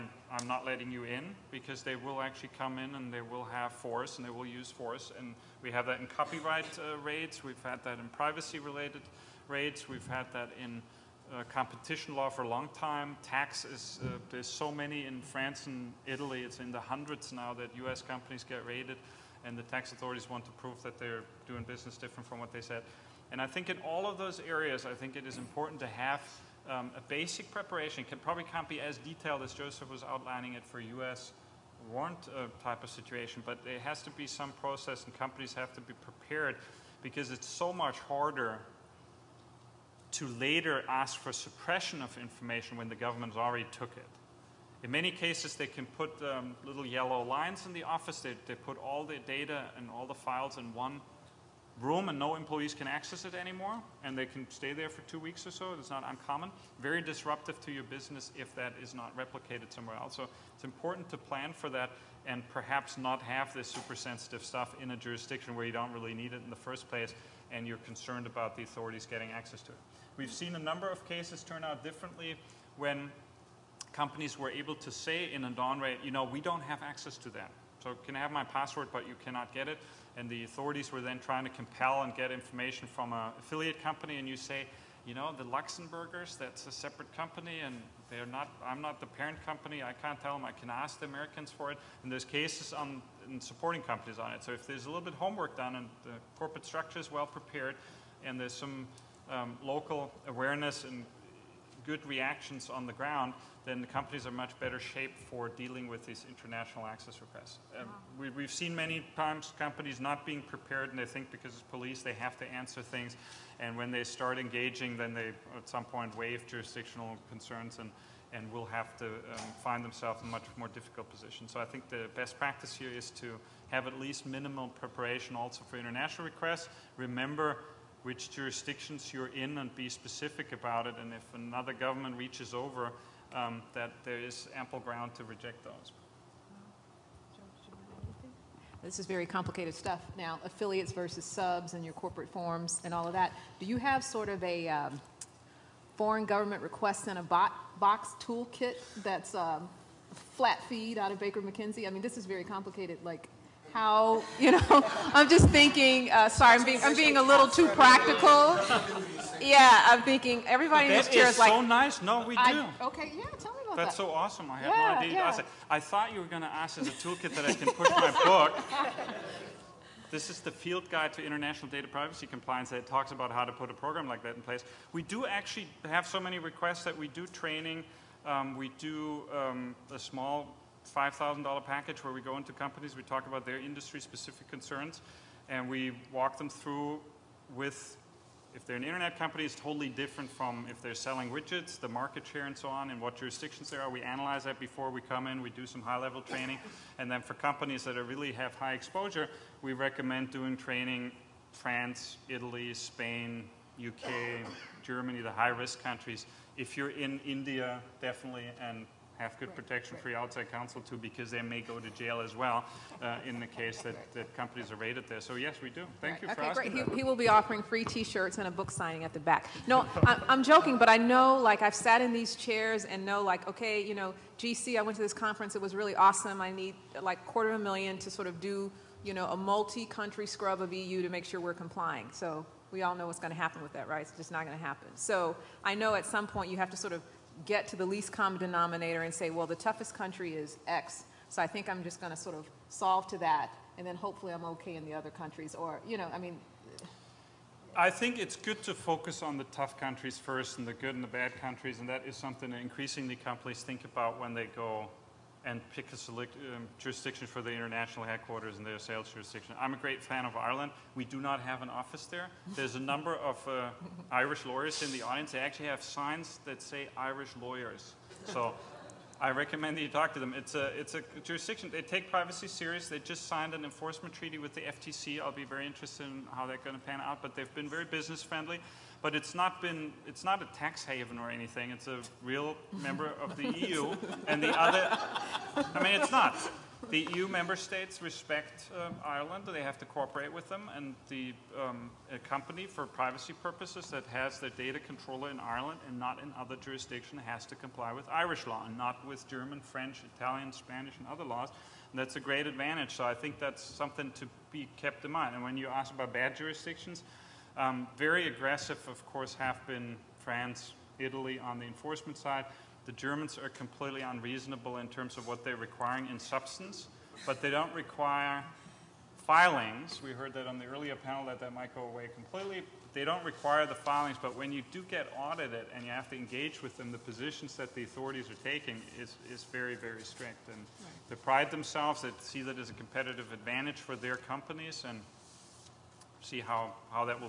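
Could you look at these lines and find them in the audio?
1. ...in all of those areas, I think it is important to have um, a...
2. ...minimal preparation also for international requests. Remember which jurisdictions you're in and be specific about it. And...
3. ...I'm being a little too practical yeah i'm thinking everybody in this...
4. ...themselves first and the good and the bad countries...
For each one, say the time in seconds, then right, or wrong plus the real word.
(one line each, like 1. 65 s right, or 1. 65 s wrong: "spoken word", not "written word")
1. 23 s right
2. 124 s right
3. 156 s right
4. 249 s wrong: "countries", not "themselves".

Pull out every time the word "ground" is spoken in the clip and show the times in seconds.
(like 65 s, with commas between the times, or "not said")
102 s, 134 s.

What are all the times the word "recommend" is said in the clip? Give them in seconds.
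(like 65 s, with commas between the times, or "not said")
199 s, 269 s.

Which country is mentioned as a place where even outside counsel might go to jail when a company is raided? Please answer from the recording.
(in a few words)
India.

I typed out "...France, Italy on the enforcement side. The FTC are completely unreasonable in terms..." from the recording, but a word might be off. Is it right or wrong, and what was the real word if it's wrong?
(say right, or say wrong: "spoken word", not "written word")
wrong: "Germans", not "FTC".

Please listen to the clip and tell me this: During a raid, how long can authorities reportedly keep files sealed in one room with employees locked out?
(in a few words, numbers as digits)
two weeks.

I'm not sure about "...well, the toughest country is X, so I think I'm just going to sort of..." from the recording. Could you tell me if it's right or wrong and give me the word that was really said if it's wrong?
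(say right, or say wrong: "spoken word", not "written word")
right.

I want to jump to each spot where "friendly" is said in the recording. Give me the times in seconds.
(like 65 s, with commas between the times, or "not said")
278 s.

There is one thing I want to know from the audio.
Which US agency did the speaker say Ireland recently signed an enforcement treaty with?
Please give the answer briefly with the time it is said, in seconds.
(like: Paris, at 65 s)
FTC, at 274 s.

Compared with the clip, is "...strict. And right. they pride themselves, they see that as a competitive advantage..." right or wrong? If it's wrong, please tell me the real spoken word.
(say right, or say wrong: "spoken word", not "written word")
right.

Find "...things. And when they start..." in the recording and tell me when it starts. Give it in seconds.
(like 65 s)
112 s.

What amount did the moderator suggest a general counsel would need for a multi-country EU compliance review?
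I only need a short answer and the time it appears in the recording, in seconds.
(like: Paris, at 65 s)
quarter of a million, at 227 s.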